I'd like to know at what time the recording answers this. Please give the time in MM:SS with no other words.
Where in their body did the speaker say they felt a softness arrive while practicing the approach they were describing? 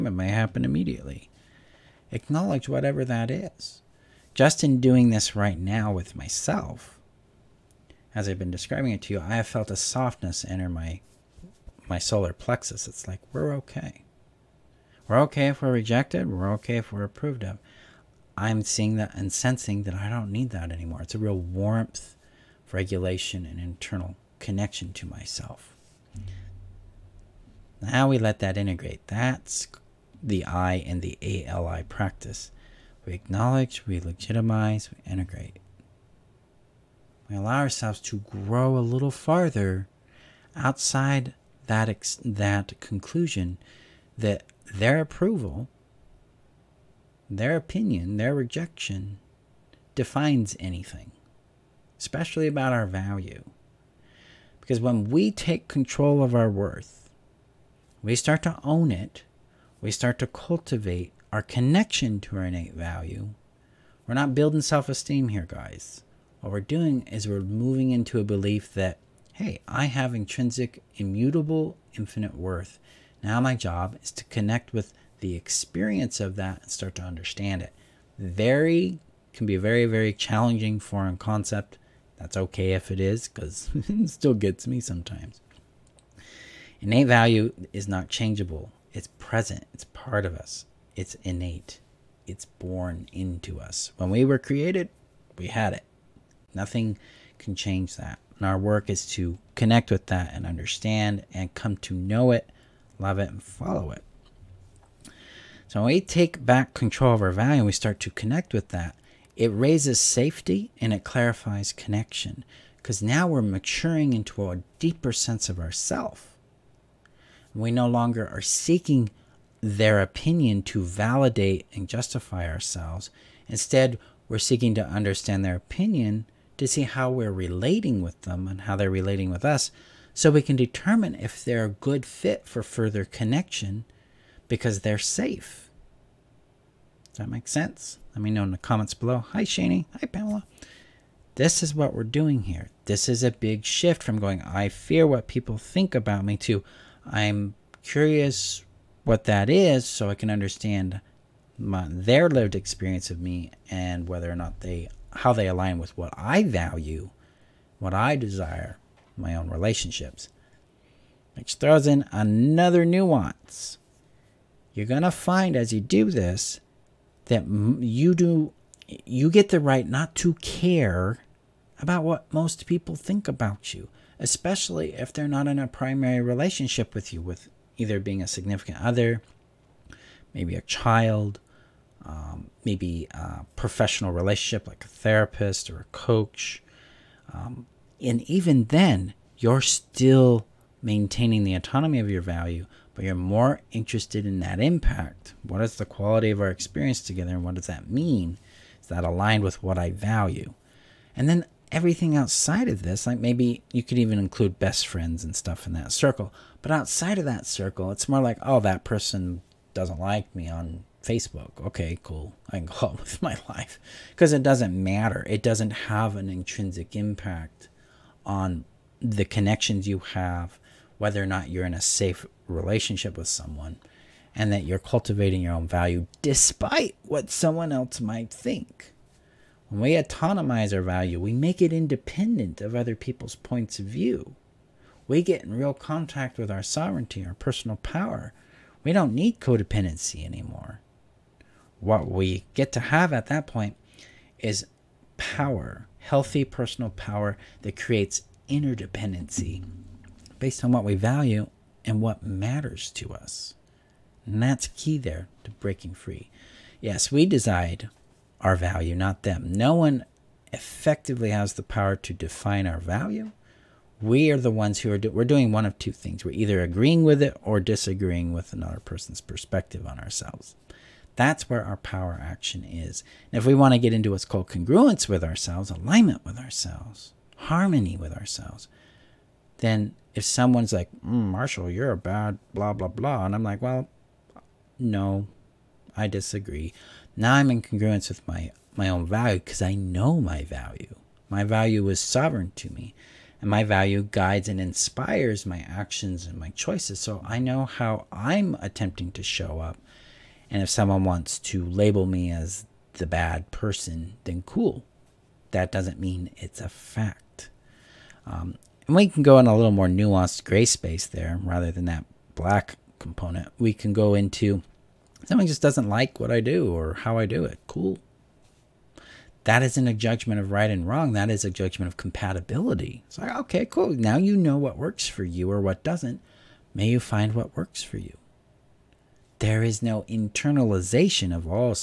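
00:11.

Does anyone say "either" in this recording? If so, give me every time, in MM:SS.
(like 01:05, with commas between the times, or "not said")
02:57, 04:26.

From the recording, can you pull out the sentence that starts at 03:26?
But outside of that circle, it's more like, oh, that person doesn't like me on Facebook.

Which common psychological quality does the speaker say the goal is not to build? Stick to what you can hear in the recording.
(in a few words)
Self esteem.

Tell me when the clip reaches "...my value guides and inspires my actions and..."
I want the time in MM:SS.
04:53.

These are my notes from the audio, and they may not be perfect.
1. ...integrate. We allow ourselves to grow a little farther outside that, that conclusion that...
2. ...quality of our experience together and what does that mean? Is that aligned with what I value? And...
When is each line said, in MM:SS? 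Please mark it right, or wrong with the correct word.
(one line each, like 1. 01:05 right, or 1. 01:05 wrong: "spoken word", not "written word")
1. 00:35 right
2. 03:15 right.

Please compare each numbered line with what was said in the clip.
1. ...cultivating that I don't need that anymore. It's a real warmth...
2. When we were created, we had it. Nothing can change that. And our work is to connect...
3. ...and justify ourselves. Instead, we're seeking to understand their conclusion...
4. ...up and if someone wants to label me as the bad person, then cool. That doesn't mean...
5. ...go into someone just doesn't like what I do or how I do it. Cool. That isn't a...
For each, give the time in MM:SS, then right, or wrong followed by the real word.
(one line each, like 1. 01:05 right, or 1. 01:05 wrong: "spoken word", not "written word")
1. 00:19 wrong: "sensing", not "cultivating"
2. 01:33 right
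3. 02:01 wrong: "opinion", not "conclusion"
4. 04:59 right
5. 05:13 right.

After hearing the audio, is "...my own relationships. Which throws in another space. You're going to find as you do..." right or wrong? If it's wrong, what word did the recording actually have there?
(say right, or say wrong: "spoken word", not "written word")
wrong: "nuance", not "space".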